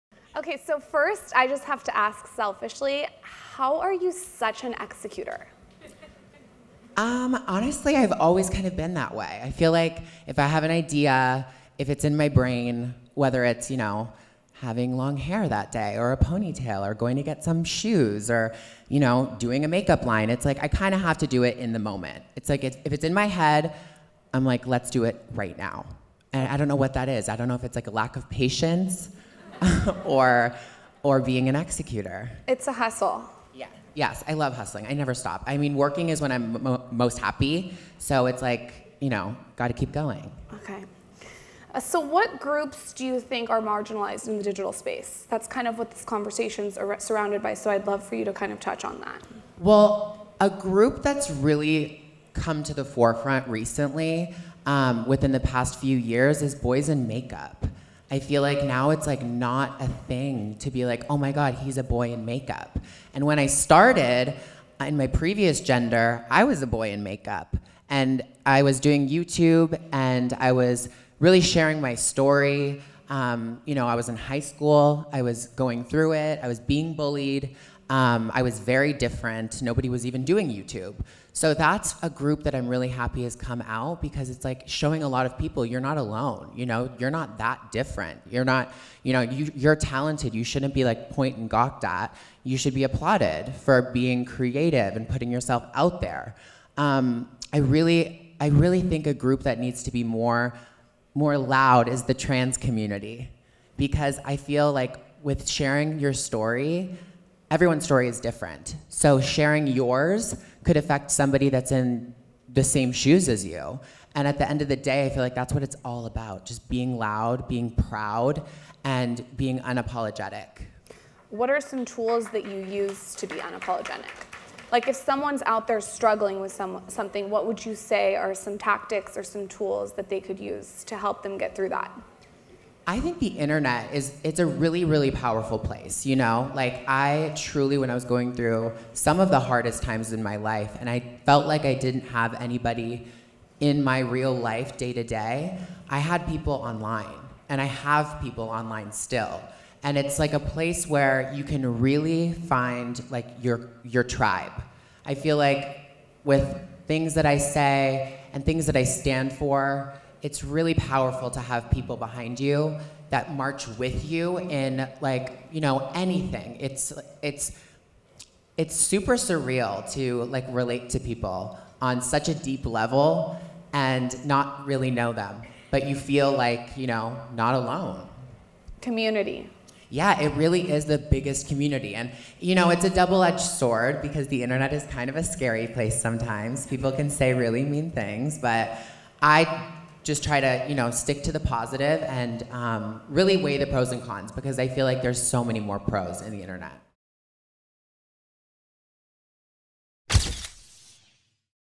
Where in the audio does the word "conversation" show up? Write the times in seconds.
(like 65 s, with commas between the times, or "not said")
46 s.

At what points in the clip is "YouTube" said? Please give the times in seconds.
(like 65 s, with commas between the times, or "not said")
69 s, 80 s.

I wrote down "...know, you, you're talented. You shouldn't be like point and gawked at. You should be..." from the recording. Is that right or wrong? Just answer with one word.
right.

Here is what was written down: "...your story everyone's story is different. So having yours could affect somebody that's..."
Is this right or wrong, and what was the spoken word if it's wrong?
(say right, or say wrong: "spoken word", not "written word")
wrong: "sharing", not "having".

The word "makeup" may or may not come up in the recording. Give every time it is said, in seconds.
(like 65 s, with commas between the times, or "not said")
19 s, 57 s, 62 s, 67 s.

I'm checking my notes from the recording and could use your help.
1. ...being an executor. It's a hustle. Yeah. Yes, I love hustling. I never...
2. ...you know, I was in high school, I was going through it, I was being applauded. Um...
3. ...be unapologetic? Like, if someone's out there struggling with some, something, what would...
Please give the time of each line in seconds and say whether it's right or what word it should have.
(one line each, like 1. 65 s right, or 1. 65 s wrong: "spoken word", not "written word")
1. 31 s right
2. 73 s wrong: "bullied", not "applauded"
3. 123 s right.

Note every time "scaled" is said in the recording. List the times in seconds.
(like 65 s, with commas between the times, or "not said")
not said.